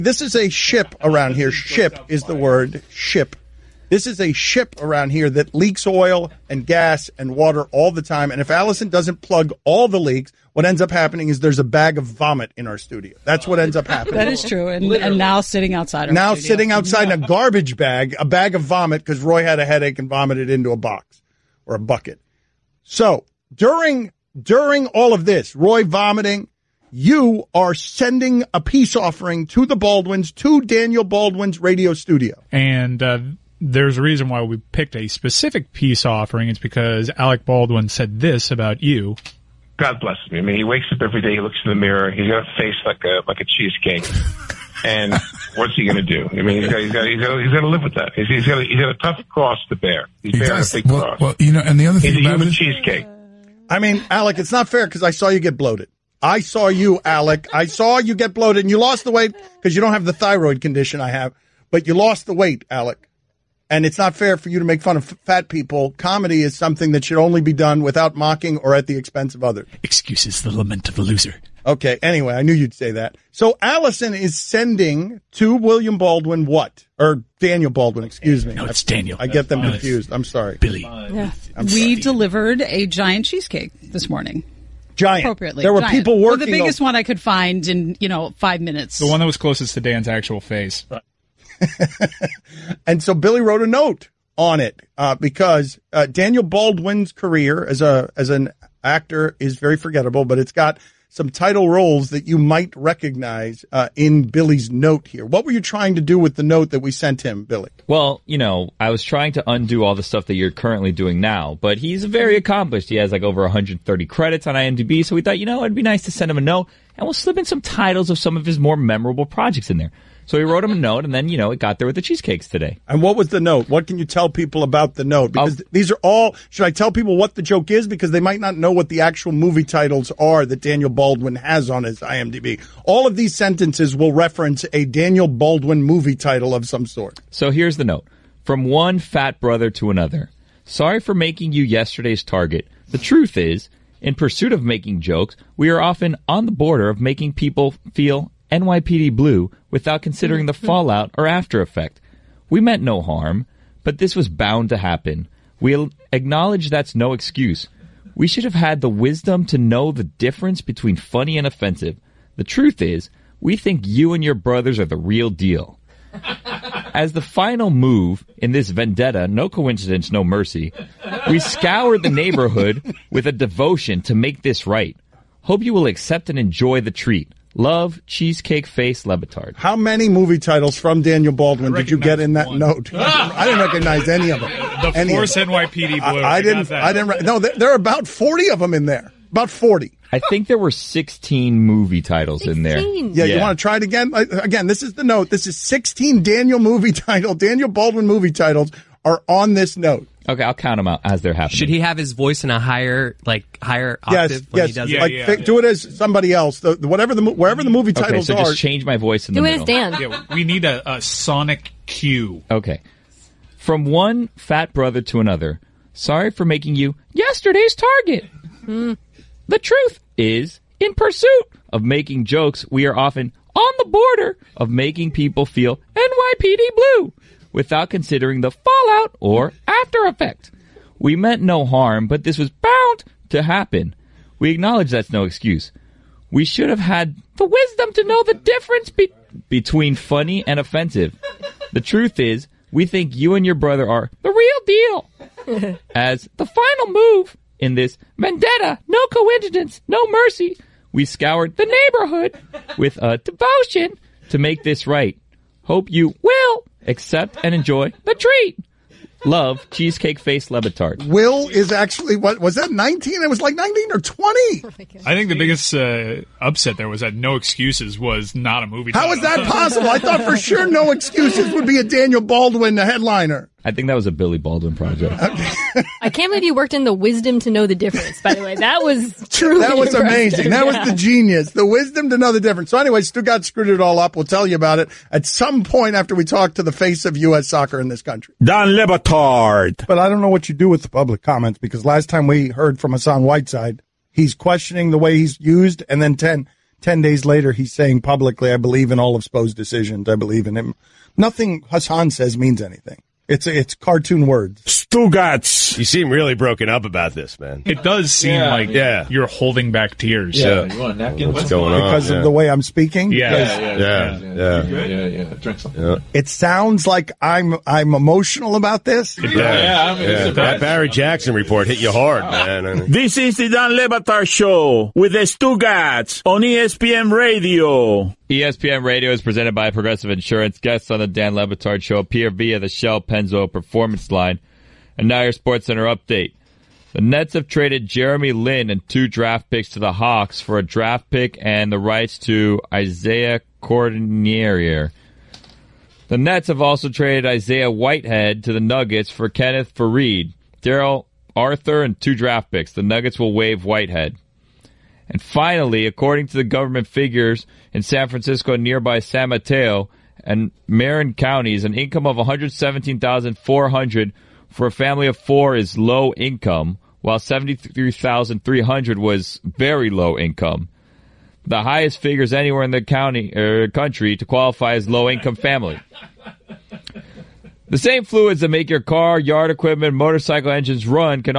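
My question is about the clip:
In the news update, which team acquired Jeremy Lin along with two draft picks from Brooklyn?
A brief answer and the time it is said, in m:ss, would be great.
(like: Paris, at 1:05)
Hawks, at 5:39.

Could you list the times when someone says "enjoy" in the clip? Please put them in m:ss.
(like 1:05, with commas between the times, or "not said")
2:56, 4:17.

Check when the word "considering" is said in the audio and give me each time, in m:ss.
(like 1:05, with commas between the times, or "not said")
2:30, 3:47.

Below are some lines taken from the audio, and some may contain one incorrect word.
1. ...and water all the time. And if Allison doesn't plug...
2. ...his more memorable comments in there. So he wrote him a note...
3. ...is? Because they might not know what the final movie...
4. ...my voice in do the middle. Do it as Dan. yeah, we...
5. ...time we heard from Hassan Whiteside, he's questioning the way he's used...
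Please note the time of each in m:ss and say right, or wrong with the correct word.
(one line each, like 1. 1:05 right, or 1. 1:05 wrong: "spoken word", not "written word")
1. 0:07 right
2. 1:58 wrong: "projects", not "comments"
3. 2:07 wrong: "actual", not "final"
4. 3:28 right
5. 4:52 right.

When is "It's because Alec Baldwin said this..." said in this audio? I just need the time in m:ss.
0:36.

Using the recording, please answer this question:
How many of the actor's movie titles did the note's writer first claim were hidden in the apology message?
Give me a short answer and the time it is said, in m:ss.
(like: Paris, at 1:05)
16, at 3:10.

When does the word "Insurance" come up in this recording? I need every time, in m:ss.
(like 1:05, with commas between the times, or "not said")
5:30.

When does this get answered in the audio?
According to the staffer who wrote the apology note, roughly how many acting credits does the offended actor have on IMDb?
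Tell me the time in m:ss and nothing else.
1:53.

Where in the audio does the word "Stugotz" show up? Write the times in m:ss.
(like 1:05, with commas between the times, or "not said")
5:04, 5:25.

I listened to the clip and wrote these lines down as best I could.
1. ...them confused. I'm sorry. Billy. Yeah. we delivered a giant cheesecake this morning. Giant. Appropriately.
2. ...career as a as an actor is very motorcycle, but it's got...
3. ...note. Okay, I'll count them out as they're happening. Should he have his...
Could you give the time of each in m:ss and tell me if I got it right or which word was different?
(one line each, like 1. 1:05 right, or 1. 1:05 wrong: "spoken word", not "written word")
1. 1:19 right
2. 1:37 wrong: "forgettable", not "motorcycle"
3. 3:19 right.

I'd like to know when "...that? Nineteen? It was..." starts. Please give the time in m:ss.
4:22.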